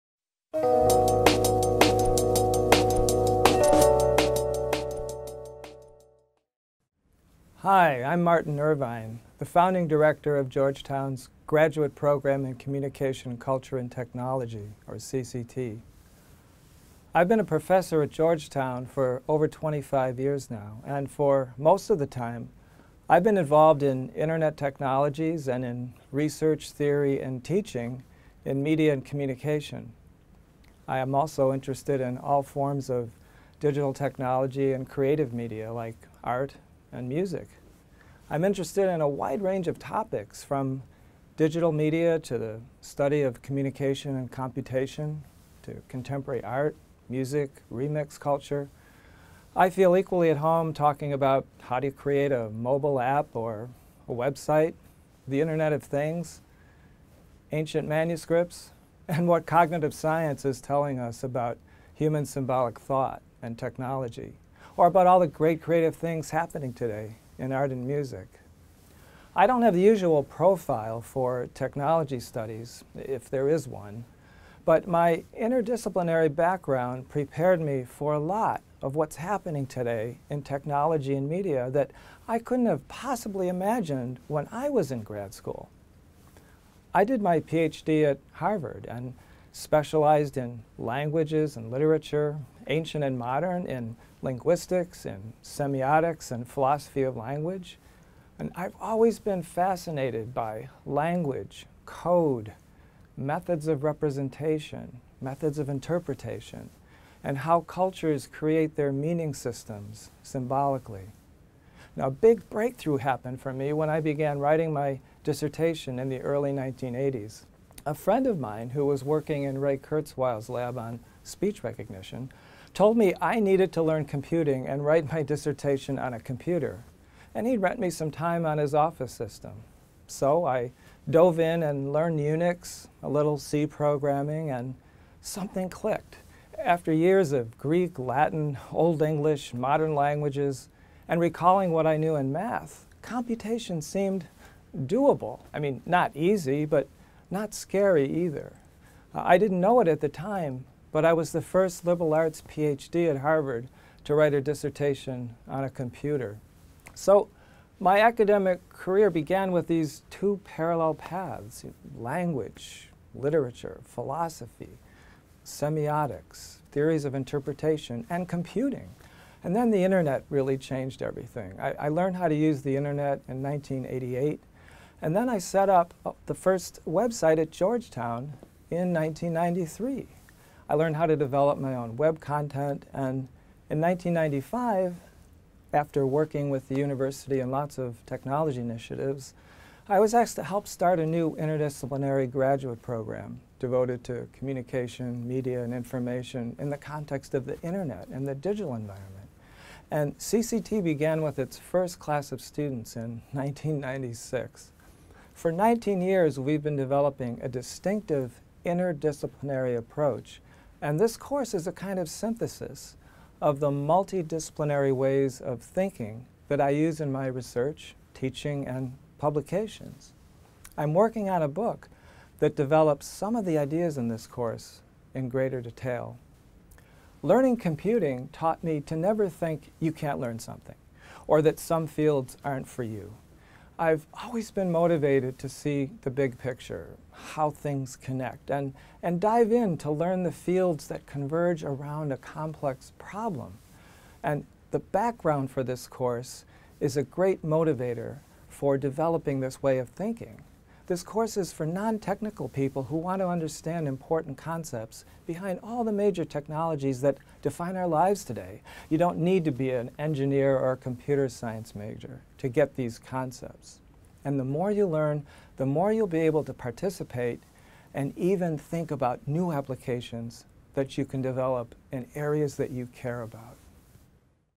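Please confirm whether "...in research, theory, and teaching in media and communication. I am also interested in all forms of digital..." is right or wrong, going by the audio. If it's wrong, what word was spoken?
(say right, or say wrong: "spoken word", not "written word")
right.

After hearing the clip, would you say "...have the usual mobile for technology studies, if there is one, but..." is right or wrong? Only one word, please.
wrong.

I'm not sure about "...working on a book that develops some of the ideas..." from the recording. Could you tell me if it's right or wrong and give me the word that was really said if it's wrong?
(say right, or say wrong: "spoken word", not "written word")
right.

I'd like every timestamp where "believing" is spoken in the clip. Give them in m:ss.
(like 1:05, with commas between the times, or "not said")
not said.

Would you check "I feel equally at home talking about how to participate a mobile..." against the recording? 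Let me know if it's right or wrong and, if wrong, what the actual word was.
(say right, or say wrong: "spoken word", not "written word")
wrong: "create", not "participate".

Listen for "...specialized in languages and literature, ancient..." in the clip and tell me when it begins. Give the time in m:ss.
1:29.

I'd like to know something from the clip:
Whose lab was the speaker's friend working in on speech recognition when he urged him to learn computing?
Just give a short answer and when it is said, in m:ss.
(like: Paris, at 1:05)
Ray Kurzweil, at 1:59.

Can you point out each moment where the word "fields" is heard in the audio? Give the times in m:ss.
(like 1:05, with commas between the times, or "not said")
3:51, 4:00.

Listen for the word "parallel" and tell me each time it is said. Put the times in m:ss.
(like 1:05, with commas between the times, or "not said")
2:40.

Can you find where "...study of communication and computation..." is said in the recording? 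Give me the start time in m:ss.
0:42.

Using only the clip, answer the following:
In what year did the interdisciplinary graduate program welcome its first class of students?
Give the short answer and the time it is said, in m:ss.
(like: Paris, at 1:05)
1996, at 3:23.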